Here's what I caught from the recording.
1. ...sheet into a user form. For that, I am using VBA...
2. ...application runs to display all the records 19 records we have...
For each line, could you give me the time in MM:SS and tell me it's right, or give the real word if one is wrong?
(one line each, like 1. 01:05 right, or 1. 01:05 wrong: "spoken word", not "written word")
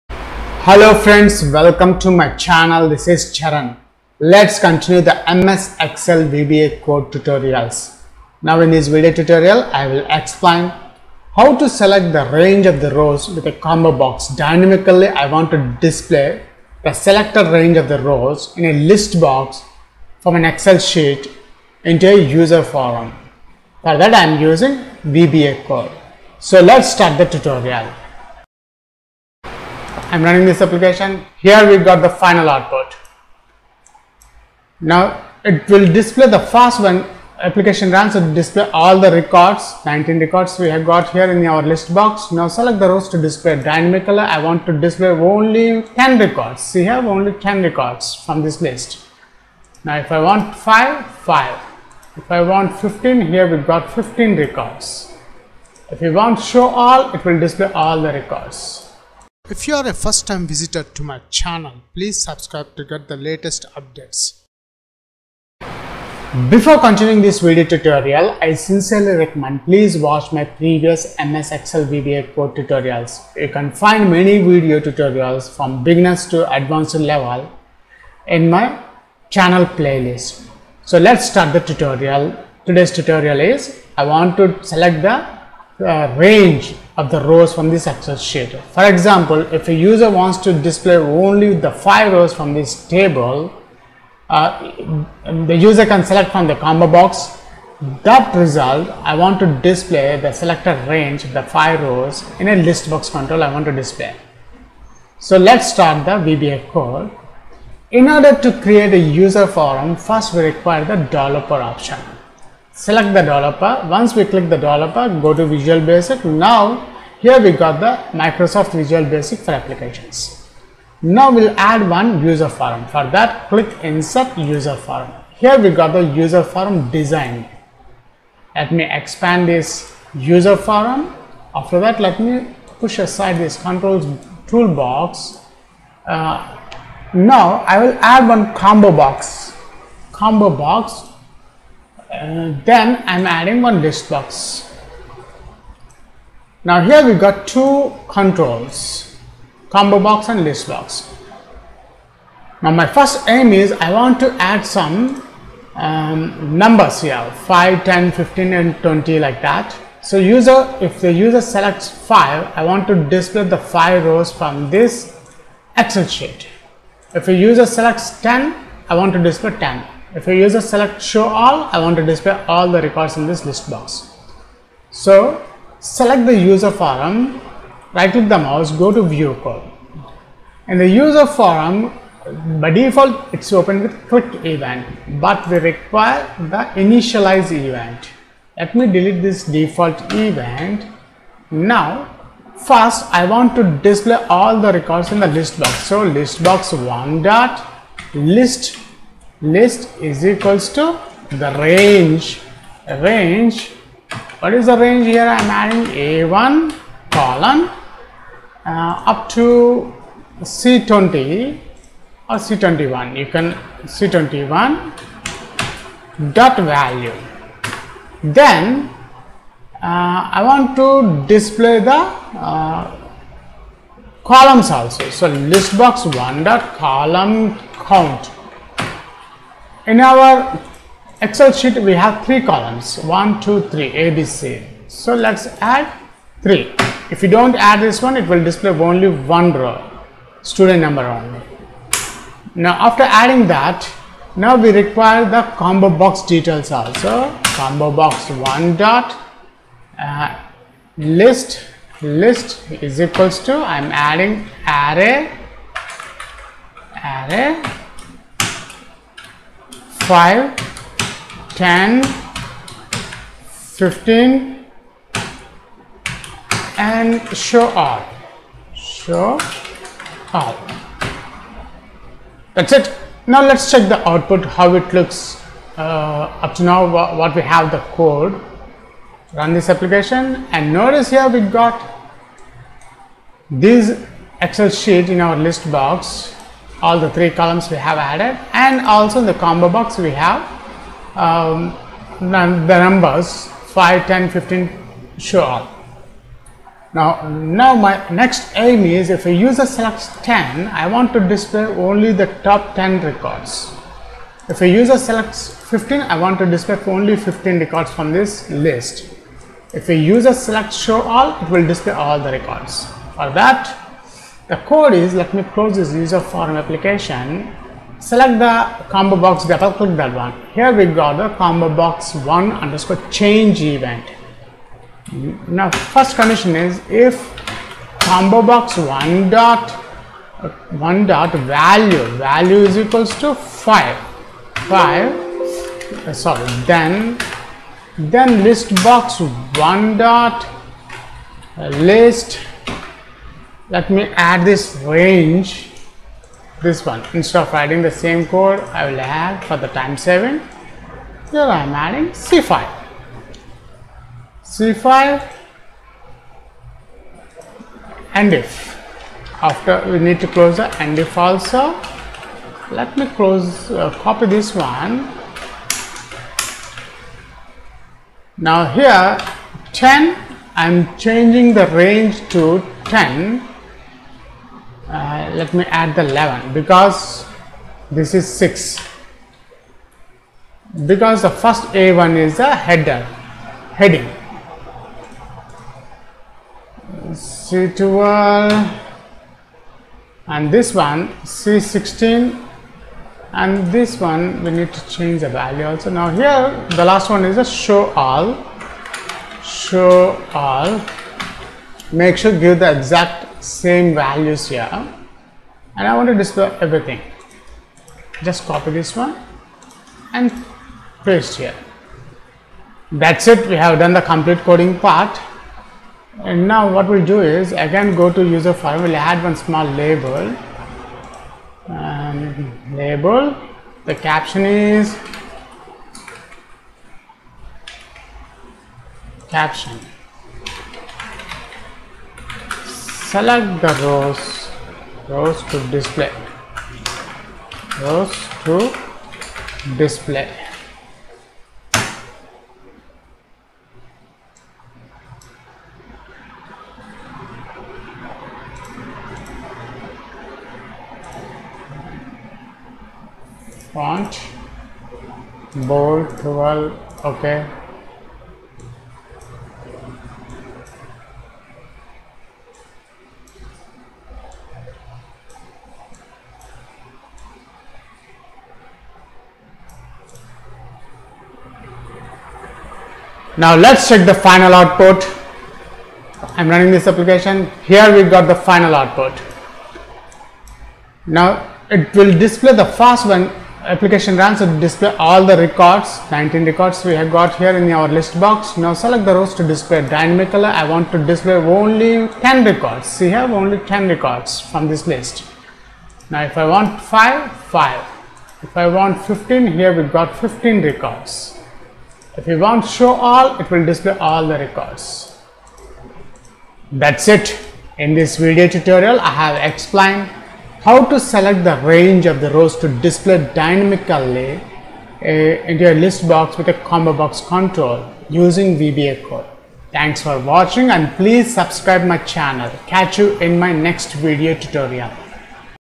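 1. 00:20 right
2. 00:37 right.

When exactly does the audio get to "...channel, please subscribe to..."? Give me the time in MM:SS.
01:01.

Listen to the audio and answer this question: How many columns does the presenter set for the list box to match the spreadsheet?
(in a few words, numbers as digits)
3.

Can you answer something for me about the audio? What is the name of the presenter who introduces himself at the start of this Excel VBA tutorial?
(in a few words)
Charan.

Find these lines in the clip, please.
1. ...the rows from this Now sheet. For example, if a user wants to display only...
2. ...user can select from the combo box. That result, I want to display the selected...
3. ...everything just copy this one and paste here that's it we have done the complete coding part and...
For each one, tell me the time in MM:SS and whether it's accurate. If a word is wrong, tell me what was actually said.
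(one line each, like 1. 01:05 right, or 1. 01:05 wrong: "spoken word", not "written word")
1. 01:27 wrong: "Excel", not "Now"
2. 01:35 right
3. 06:46 right.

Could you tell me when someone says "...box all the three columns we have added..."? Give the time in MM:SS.
04:45.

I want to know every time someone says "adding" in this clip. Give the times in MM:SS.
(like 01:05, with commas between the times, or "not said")
02:23, 03:25, 04:03, 04:13, 05:47, 05:51.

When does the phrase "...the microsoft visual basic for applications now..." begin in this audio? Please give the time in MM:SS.
01:57.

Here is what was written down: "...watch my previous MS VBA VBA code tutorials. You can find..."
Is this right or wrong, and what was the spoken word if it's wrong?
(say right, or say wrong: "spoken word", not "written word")
wrong: "Excel", not "VBA".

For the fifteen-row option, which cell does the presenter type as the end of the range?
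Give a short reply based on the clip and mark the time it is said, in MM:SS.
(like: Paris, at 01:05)
C16, at 06:31.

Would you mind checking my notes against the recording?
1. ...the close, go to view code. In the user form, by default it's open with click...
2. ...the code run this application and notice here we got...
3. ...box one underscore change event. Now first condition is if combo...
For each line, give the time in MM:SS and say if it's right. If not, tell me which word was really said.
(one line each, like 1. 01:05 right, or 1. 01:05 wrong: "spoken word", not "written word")
1. 02:58 wrong: "mouse", not "close"
2. 04:37 right
3. 05:21 right.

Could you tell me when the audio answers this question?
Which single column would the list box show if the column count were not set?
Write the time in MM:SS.
04:00.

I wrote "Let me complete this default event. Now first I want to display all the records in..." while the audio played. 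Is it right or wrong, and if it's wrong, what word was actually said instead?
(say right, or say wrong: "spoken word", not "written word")
wrong: "delete", not "complete".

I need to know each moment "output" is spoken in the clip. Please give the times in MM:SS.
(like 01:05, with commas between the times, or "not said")
00:32, 04:34, 07:54, 07:58.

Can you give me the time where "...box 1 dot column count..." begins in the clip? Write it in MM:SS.
03:45.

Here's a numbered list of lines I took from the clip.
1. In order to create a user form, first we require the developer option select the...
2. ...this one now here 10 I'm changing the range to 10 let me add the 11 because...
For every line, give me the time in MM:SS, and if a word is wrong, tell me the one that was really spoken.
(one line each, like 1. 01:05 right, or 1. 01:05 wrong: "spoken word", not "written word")
1. 01:47 right
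2. 06:04 right.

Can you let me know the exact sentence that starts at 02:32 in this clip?
Now my first aim is I want to add some um, numbers here 5, 10, 15 and 20 like that.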